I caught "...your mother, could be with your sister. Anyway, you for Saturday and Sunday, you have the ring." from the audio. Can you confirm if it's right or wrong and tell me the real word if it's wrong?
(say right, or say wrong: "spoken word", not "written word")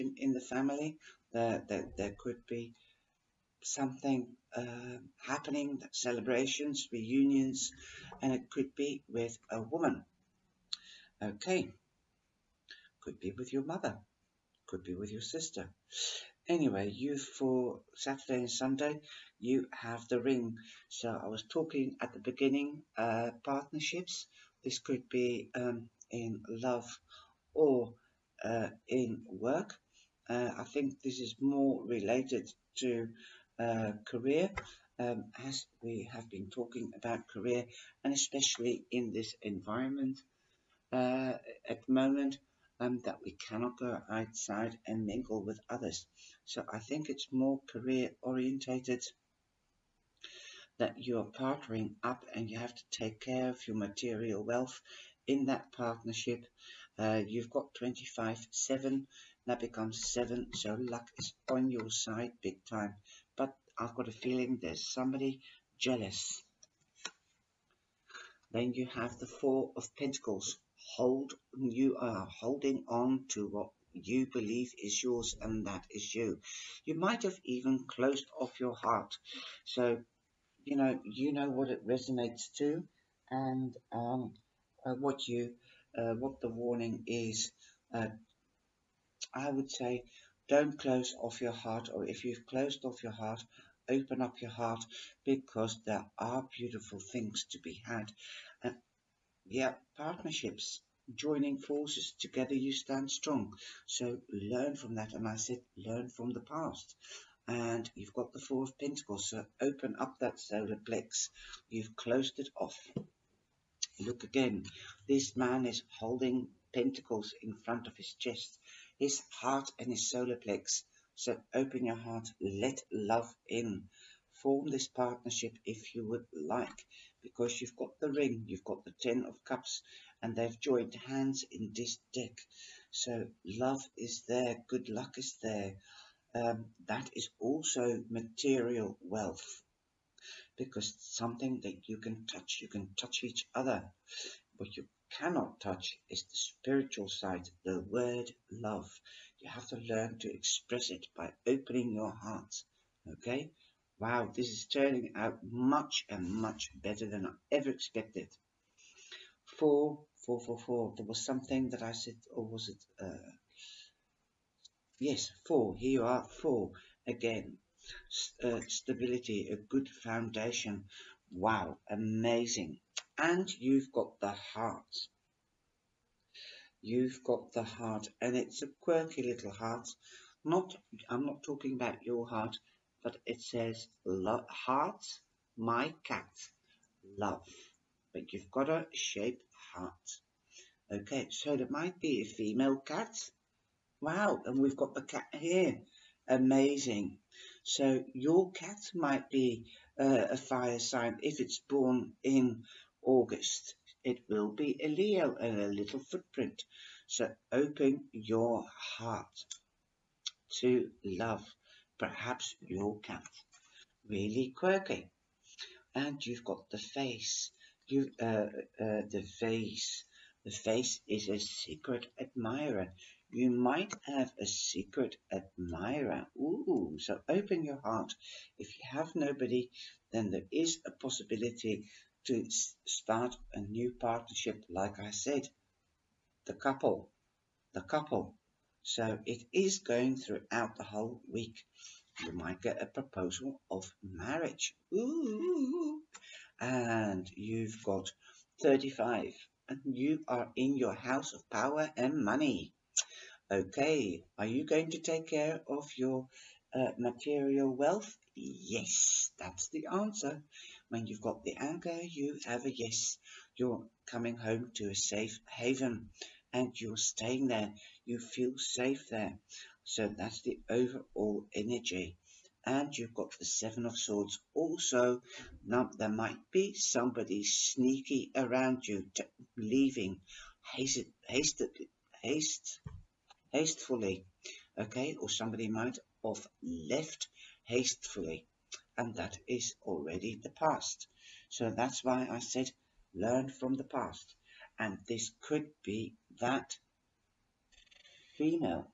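right.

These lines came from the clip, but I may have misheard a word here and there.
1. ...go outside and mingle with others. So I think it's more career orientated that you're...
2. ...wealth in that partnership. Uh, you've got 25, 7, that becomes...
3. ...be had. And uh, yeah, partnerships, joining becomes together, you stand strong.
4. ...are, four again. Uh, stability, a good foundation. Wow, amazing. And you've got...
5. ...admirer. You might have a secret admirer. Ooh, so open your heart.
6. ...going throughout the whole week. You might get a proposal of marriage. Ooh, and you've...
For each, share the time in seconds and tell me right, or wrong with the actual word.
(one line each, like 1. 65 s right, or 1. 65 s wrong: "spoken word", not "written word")
1. 43 s right
2. 54 s right
3. 97 s wrong: "forces", not "becomes"
4. 166 s right
5. 222 s right
6. 239 s right.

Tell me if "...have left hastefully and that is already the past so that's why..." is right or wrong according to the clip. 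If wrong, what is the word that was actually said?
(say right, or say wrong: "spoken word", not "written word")
right.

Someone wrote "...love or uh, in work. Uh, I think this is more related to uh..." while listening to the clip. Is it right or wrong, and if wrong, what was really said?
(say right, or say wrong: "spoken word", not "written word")
right.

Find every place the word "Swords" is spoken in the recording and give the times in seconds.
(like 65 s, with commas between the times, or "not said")
273 s.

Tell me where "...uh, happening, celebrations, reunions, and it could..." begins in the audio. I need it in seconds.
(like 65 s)
4 s.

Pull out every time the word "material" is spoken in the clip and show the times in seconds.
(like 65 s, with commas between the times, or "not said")
53 s, 138 s, 256 s.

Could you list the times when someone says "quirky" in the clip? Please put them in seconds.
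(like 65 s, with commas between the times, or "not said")
178 s, 214 s.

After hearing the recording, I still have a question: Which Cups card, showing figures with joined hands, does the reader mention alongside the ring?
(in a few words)
Ten of Cups.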